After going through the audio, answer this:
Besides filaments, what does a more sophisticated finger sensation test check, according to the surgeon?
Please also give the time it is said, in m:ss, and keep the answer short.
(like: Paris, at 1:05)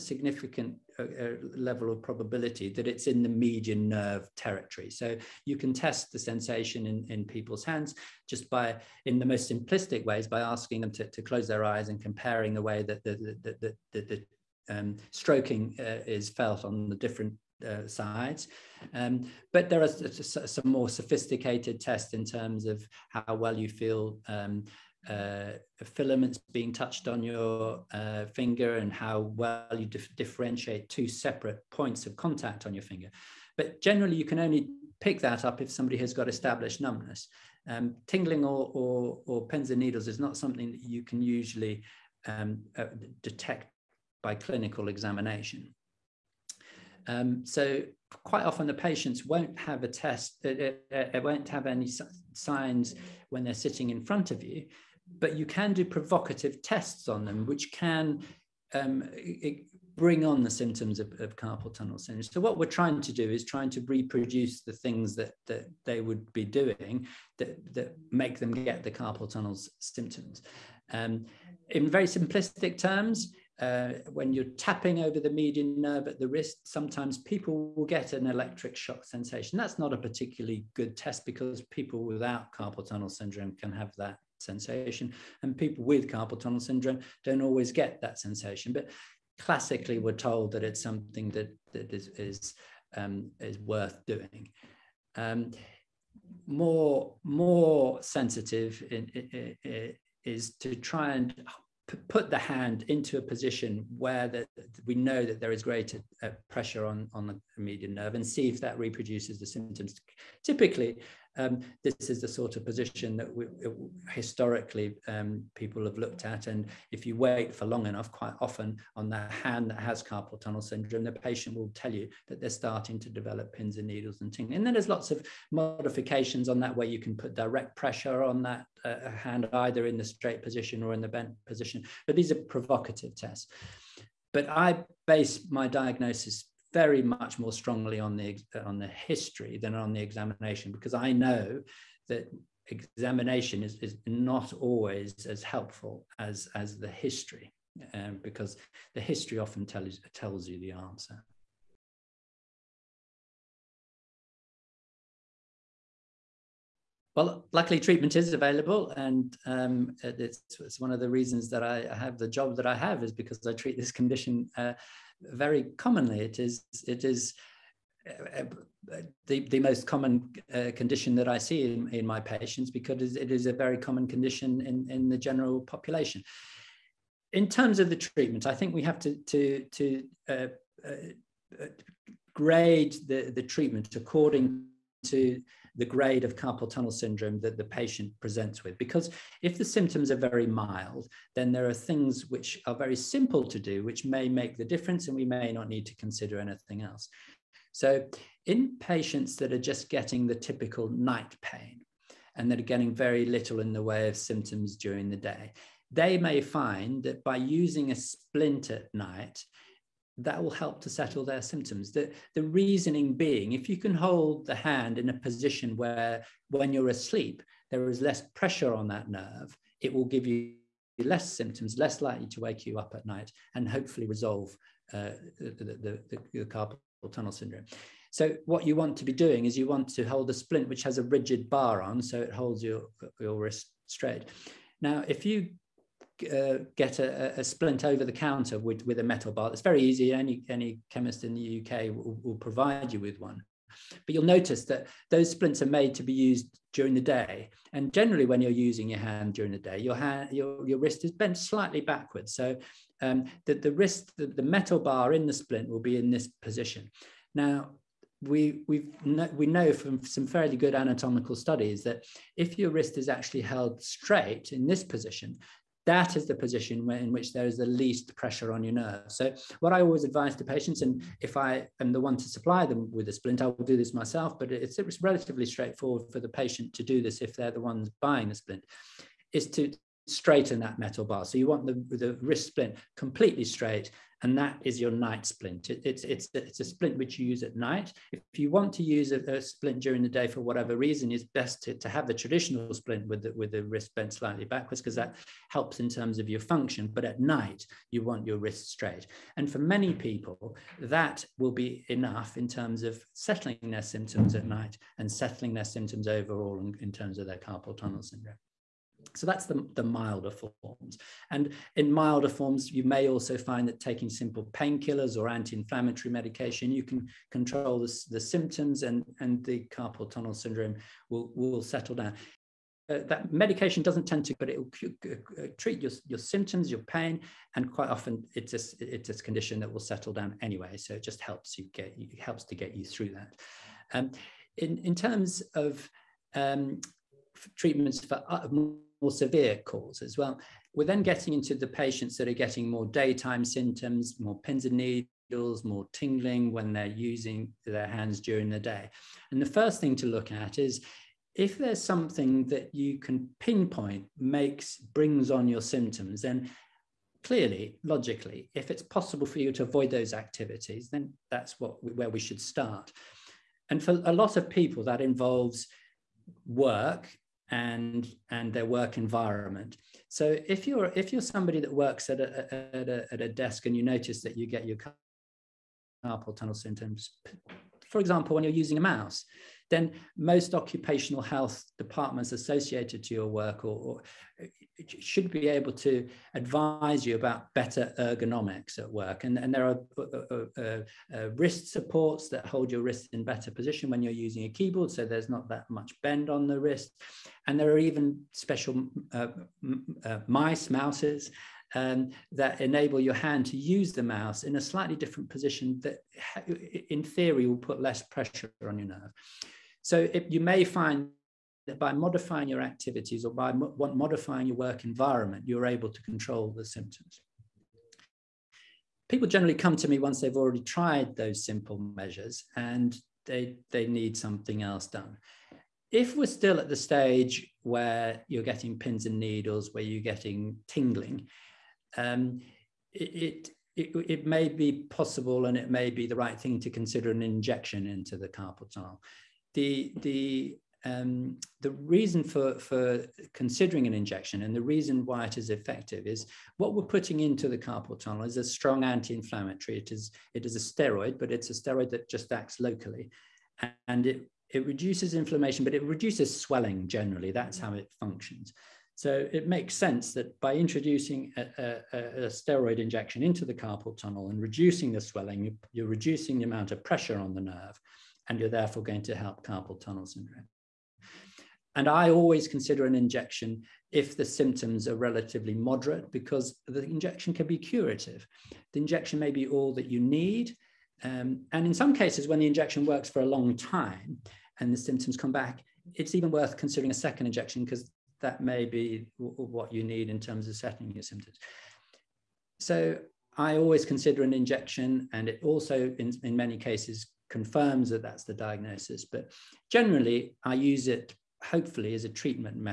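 two separate points of contact, at 0:30.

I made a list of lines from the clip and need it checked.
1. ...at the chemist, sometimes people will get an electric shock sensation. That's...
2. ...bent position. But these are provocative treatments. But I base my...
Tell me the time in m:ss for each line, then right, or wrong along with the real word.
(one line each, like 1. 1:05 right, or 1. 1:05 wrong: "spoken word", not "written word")
1. 1:16 wrong: "wrist", not "chemist"
2. 2:11 wrong: "tests", not "treatments".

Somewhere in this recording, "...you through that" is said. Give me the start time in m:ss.
5:32.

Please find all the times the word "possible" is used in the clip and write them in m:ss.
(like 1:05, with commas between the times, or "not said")
5:58, 7:14.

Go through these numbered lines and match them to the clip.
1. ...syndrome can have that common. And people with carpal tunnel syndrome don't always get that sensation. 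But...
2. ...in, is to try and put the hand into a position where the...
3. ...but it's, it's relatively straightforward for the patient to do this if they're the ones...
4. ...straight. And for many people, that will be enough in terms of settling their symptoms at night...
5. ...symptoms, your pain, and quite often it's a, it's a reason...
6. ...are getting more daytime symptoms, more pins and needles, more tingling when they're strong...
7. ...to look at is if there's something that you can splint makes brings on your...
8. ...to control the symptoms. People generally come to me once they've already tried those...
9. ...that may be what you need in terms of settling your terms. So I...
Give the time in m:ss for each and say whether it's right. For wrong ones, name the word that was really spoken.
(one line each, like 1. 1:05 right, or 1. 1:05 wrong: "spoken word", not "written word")
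1. 1:23 wrong: "sensation", not "common"
2. 1:39 right
3. 4:34 right
4. 4:58 right
5. 5:26 wrong: "condition", not "reason"
6. 5:42 wrong: "using", not "strong"
7. 5:49 wrong: "pinpoint", not "splint"
8. 6:55 right
9. 8:08 wrong: "symptoms", not "terms".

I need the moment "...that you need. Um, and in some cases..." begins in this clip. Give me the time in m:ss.
7:59.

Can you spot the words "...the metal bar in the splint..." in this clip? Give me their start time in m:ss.
4:14.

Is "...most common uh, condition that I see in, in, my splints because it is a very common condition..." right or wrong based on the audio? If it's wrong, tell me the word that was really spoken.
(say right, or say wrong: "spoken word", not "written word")
wrong: "patients", not "splints".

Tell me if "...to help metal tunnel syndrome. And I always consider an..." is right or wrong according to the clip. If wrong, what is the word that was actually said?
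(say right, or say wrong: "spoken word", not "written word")
wrong: "carpal", not "metal".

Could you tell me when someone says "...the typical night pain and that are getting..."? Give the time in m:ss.
3:20.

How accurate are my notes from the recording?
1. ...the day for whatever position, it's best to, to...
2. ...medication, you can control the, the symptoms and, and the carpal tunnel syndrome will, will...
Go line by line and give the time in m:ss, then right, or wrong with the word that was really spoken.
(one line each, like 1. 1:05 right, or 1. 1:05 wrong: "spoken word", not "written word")
1. 4:50 wrong: "reason", not "position"
2. 5:16 right.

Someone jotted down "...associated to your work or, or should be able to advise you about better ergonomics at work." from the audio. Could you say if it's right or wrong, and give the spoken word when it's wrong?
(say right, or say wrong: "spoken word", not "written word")
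right.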